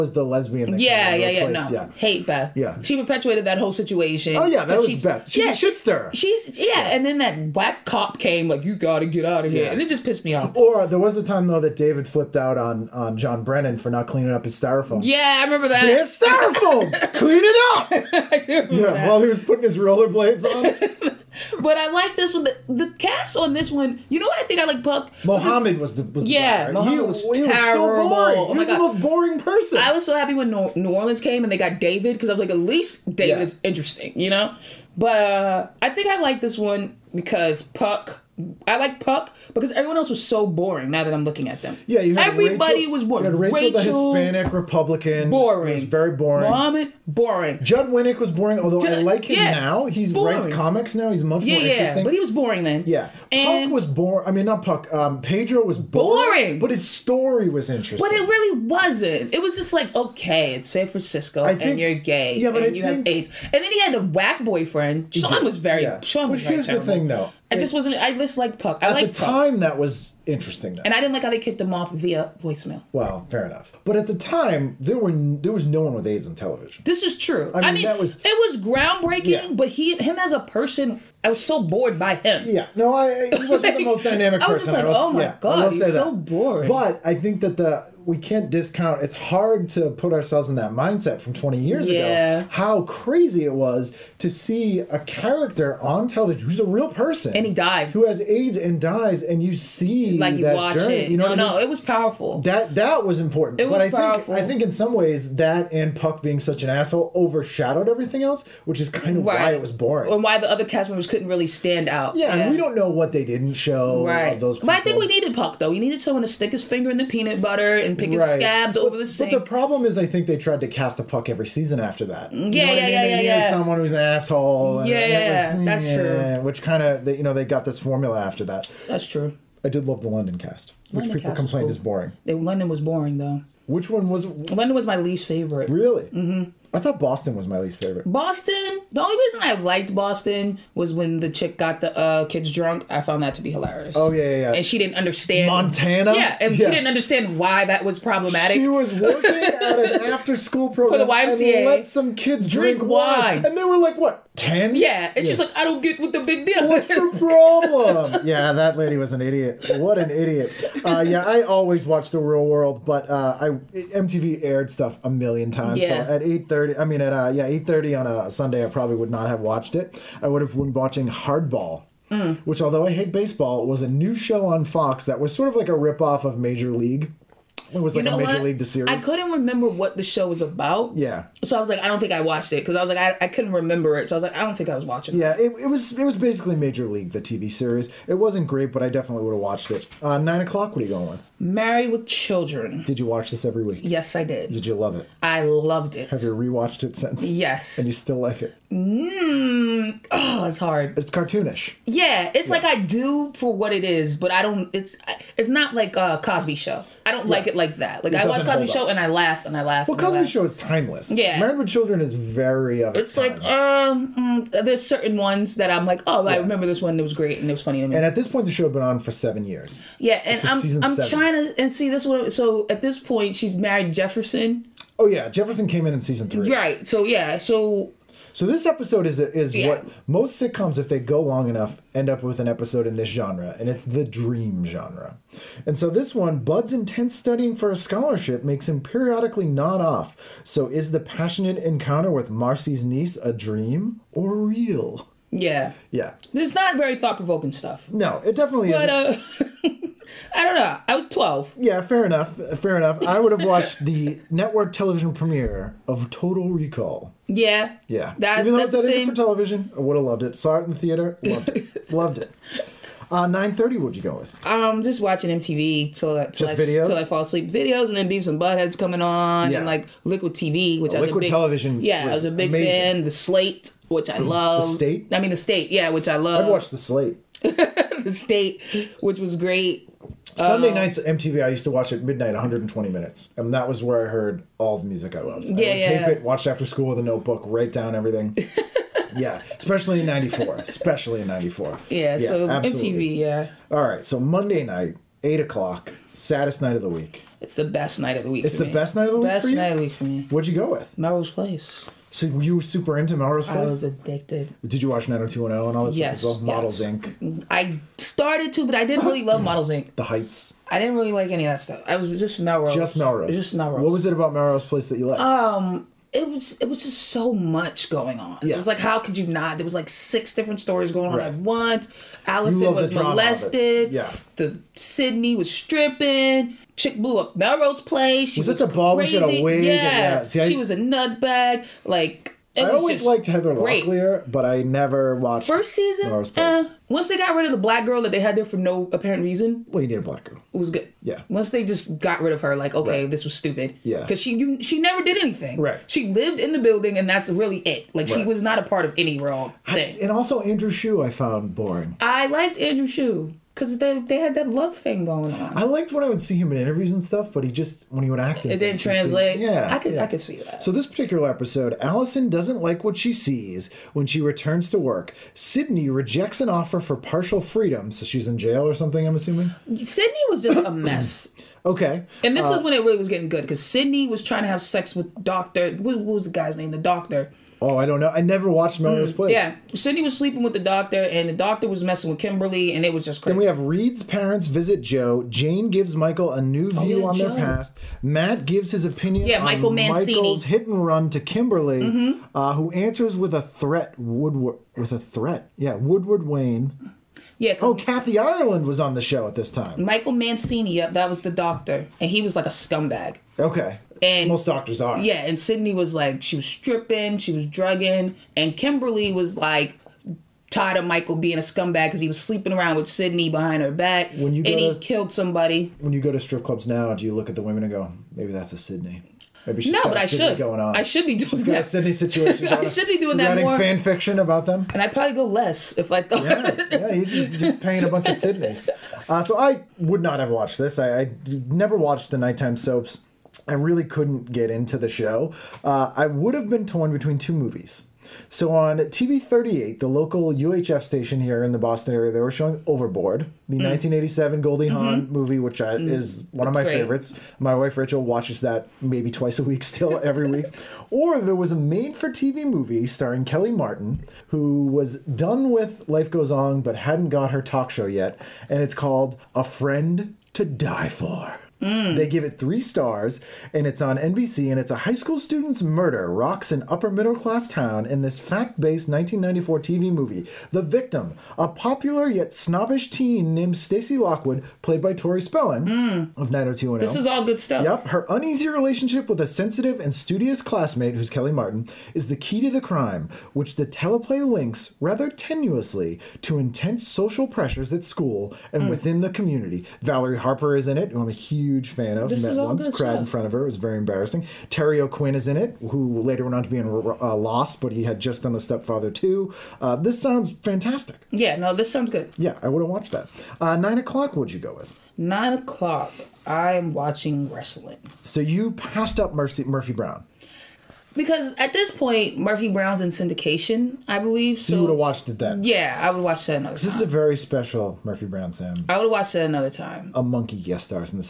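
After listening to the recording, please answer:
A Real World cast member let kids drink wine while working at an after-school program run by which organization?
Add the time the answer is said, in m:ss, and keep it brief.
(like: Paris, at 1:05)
YMCA, at 2:31.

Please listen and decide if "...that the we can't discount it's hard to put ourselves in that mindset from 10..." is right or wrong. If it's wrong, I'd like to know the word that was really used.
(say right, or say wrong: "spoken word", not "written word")
wrong: "20", not "10".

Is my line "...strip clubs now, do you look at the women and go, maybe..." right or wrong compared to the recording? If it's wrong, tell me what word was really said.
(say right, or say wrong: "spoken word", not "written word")
right.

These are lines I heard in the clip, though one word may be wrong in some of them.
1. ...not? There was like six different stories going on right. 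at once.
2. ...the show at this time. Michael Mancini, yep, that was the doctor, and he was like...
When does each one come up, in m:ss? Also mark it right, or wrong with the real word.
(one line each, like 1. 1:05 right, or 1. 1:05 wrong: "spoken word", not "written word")
1. 5:19 right
2. 6:38 right.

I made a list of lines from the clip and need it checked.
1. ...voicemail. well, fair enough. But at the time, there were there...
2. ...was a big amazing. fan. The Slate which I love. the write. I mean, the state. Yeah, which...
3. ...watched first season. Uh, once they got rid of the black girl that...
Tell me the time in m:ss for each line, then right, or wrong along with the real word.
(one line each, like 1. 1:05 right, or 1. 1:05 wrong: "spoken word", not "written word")
1. 1:12 right
2. 4:32 wrong: "state", not "write"
3. 5:35 right.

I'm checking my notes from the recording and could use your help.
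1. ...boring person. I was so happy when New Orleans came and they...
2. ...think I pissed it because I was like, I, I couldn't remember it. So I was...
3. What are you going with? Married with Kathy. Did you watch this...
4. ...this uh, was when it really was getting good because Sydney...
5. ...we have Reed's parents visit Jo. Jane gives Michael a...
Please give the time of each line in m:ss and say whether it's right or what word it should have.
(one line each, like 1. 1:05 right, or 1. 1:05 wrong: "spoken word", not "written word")
1. 0:29 right
2. 3:02 wrong: "watched", not "pissed"
3. 3:10 wrong: "Children", not "Kathy"
4. 6:12 right
5. 6:23 right.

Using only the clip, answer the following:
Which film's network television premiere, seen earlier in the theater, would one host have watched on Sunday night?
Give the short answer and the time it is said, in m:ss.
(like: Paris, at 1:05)
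Total Recall, at 4:16.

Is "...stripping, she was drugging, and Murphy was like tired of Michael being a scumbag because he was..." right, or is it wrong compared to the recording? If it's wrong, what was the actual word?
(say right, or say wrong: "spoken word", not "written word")
wrong: "Kimberly", not "Murphy".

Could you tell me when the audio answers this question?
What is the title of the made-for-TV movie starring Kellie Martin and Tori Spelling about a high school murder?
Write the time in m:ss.
7:39.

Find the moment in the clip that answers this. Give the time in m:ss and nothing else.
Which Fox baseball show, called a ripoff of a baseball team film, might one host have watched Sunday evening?
2:51.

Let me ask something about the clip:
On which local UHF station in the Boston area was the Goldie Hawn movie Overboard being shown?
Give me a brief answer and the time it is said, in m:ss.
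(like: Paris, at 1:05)
TV 38, at 7:18.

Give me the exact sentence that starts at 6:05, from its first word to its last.
Sydney rejects an offer for partial freedom, so she's in jail or something.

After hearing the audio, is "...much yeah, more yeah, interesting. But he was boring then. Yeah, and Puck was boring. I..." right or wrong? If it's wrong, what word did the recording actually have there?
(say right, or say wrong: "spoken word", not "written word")
right.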